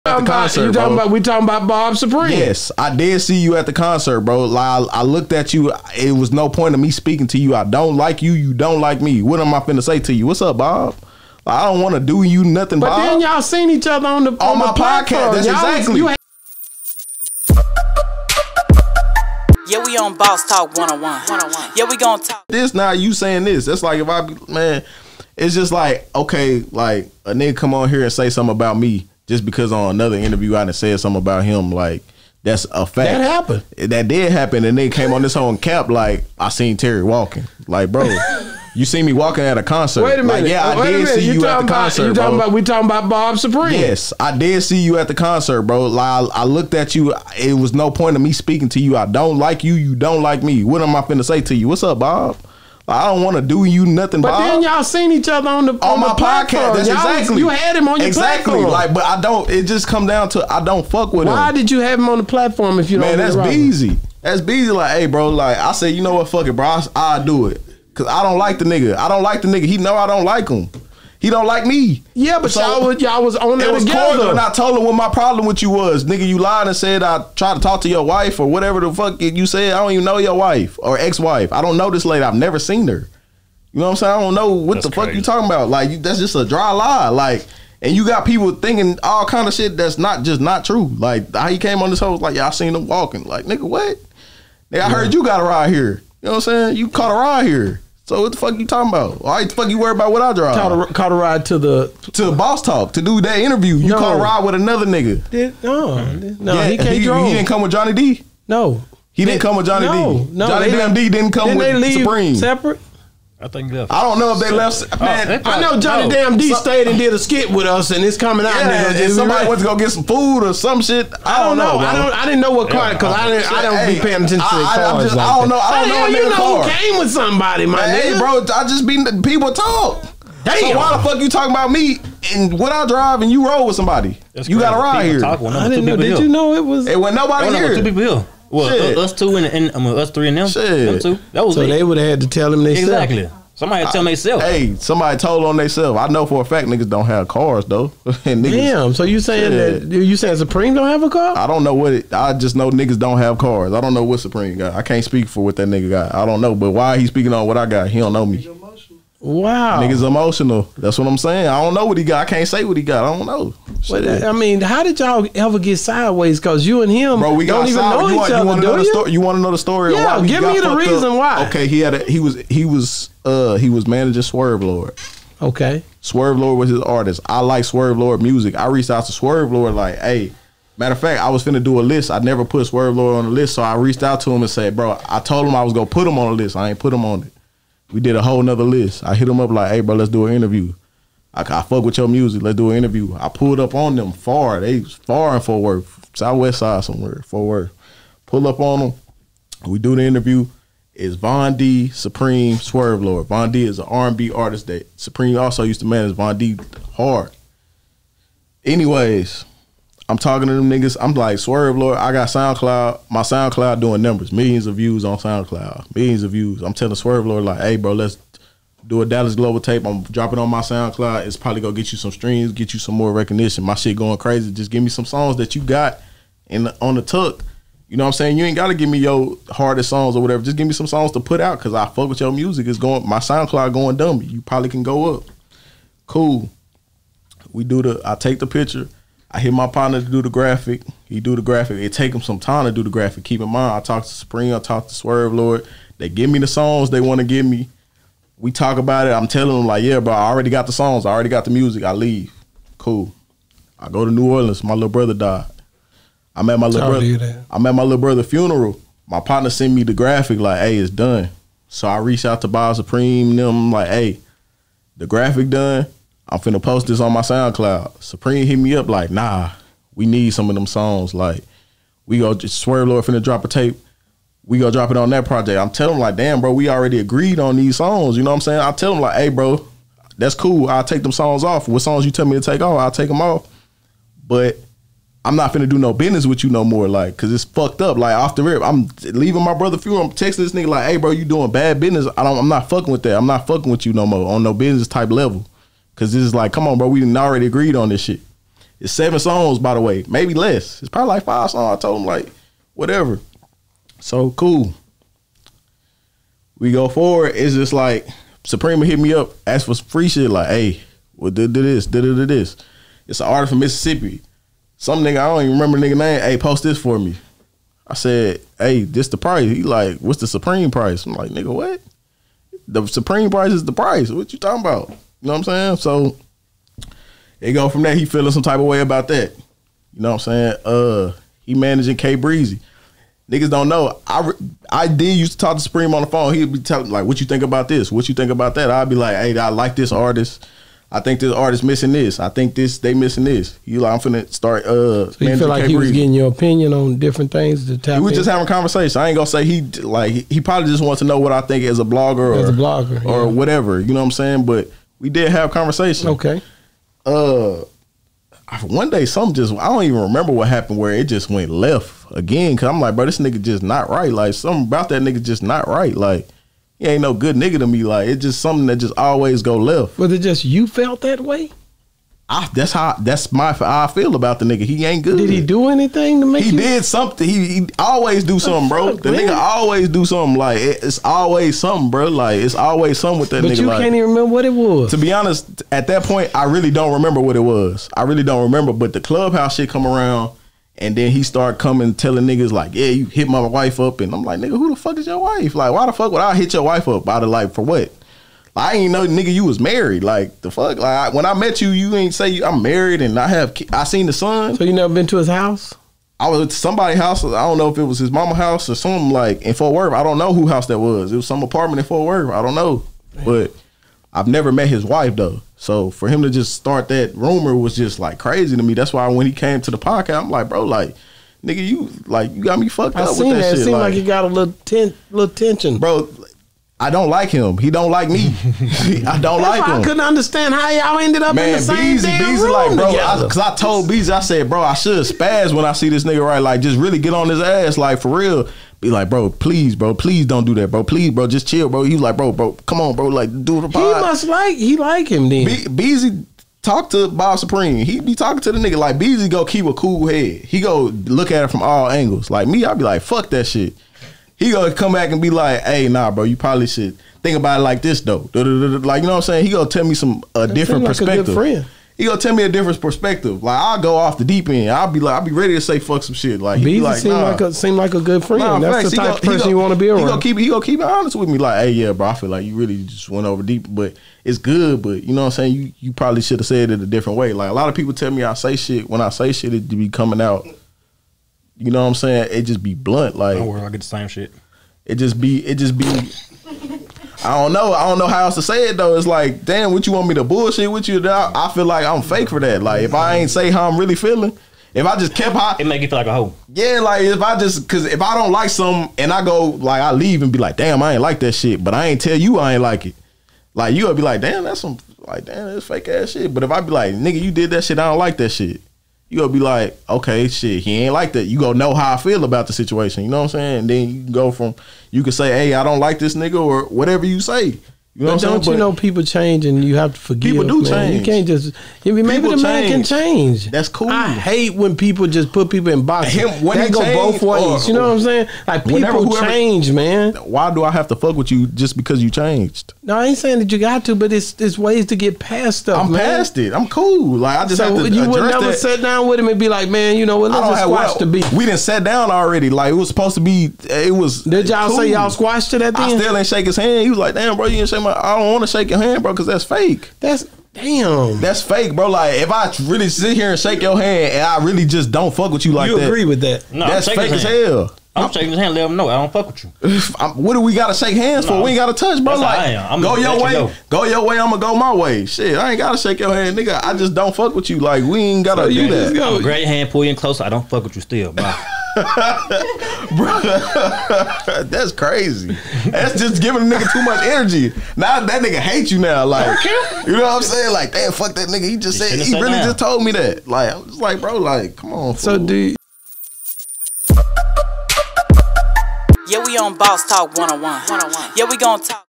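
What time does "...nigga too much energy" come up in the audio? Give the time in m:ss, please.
9:36.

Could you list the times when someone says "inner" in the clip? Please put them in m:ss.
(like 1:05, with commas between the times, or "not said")
not said.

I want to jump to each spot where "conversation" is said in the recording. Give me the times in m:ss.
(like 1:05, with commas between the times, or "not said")
5:48, 5:55.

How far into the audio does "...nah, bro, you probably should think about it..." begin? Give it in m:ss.
7:35.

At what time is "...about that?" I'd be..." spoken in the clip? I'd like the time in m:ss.
5:38.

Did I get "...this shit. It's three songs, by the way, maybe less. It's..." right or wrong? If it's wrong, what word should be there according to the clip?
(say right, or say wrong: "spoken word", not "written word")
wrong: "seven", not "three".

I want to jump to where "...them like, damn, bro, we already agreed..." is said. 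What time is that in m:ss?
4:35.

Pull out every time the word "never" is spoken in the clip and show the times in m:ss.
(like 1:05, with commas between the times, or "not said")
1:22, 3:02, 6:44, 6:54, 8:58.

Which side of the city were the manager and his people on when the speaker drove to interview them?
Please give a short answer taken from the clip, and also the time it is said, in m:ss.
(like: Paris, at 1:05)
Southwest side, at 3:16.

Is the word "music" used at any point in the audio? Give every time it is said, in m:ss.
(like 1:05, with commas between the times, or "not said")
2:58, 3:12, 3:52, 4:11.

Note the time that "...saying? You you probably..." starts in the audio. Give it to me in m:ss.
7:55.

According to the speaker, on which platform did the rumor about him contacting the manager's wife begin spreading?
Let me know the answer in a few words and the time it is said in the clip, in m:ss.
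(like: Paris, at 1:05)
Clubhouse, at 6:29.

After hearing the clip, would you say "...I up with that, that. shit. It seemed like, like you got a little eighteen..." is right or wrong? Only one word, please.
wrong.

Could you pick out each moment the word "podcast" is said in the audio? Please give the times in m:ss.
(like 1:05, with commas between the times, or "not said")
0:14, 0:56, 6:59.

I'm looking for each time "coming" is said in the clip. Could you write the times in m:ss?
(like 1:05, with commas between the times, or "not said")
1:58, 6:31, 7:59.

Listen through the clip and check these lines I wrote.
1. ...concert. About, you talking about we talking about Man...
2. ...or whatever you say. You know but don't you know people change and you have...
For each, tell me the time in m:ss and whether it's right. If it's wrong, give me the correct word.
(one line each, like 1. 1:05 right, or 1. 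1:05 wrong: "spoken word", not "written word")
1. 0:00 wrong: "Bob", not "Man"
2. 8:36 right.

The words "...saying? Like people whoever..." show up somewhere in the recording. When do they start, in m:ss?
8:47.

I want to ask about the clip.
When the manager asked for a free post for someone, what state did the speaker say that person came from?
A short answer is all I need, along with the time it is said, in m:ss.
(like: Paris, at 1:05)
Mississippi, at 5:13.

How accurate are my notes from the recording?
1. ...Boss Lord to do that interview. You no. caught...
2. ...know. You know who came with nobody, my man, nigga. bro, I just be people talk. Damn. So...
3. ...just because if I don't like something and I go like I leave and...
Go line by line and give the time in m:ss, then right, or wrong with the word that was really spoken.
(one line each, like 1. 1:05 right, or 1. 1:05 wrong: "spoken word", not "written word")
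1. 1:42 wrong: "Talk", not "Lord"
2. 2:06 wrong: "somebody", not "nobody"
3. 8:17 right.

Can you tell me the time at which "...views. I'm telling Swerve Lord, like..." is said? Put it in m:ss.
3:36.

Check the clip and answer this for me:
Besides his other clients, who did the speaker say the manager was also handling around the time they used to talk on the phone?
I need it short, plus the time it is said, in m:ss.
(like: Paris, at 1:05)
K Breezy, at 5:31.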